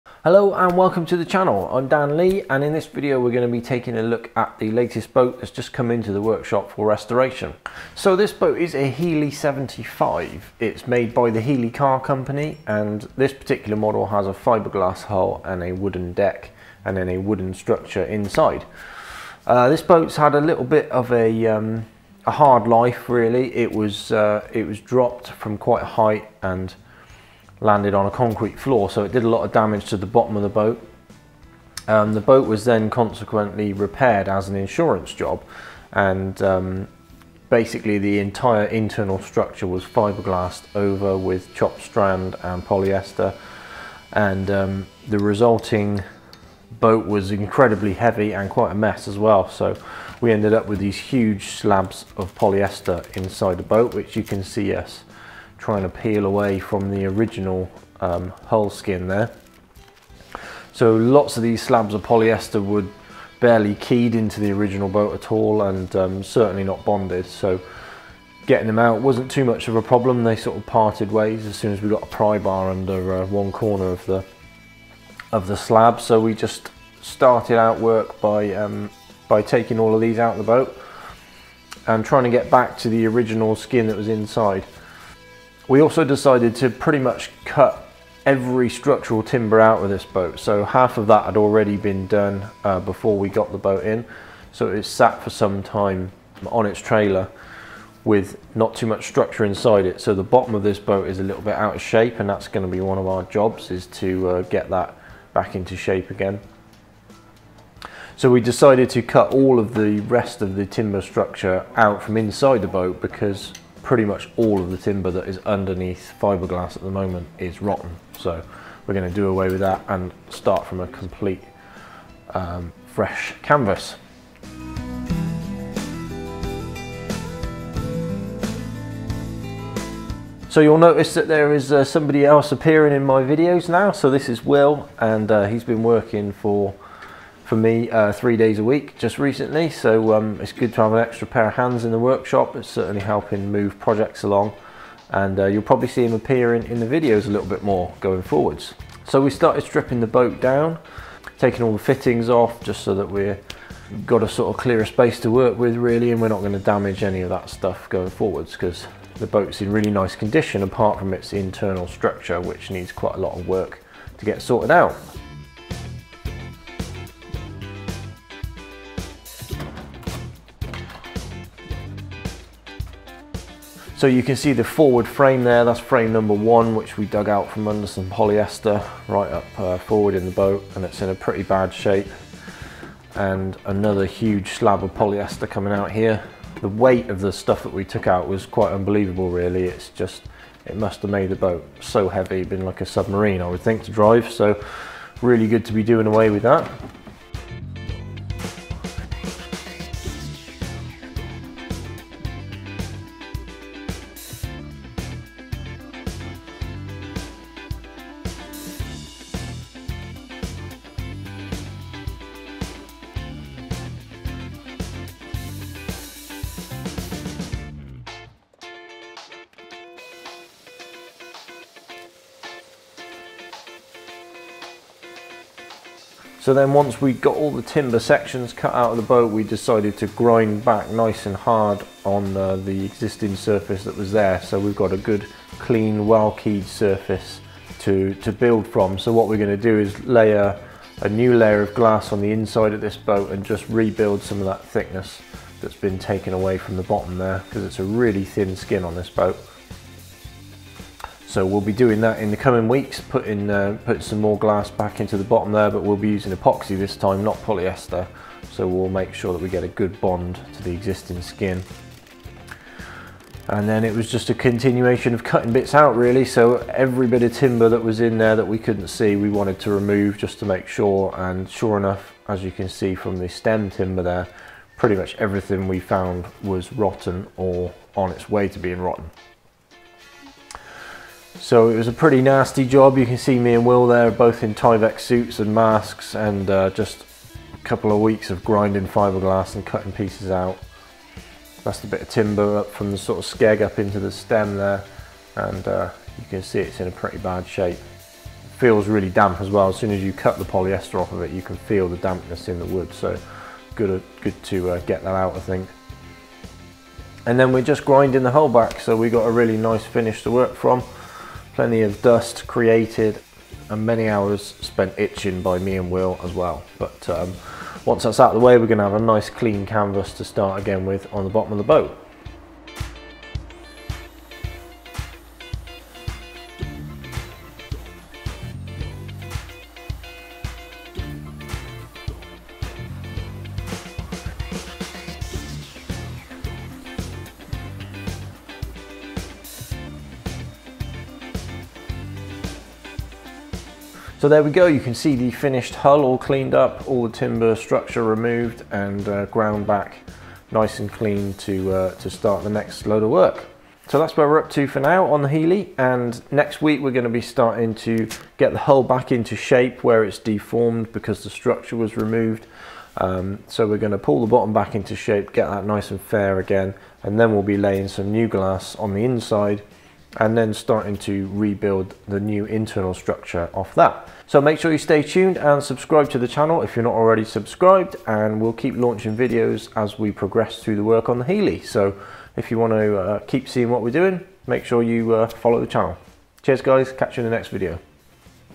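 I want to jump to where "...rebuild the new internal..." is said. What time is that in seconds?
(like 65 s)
371 s.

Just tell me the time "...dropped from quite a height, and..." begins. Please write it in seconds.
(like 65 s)
24 s.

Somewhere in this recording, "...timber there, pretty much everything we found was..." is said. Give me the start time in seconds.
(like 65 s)
273 s.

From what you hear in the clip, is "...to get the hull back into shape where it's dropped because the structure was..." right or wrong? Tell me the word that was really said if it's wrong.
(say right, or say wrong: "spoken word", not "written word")
wrong: "deformed", not "dropped".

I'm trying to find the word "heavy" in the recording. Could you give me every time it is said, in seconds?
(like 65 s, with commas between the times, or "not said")
47 s, 192 s.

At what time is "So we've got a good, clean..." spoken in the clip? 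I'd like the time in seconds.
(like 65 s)
234 s.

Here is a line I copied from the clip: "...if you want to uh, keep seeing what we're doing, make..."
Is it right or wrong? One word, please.
right.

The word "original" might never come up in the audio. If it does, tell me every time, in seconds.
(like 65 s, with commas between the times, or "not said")
57 s, 64 s, 83 s.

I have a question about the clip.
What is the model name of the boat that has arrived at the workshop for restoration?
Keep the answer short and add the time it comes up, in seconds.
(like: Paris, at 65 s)
Healey 75, at 8 s.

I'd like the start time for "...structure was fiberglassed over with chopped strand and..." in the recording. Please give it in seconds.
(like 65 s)
39 s.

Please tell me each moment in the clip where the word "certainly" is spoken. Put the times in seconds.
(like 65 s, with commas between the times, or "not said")
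66 s, 142 s.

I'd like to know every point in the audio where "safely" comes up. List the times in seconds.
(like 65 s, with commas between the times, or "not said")
not said.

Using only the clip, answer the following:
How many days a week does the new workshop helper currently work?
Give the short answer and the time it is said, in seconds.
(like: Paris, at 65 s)
3, at 138 s.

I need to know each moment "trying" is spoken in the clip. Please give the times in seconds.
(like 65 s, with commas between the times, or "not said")
55 s, 82 s.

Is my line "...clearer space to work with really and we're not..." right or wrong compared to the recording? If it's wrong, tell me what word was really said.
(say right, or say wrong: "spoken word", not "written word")
right.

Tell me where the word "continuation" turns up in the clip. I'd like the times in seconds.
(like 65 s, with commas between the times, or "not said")
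264 s.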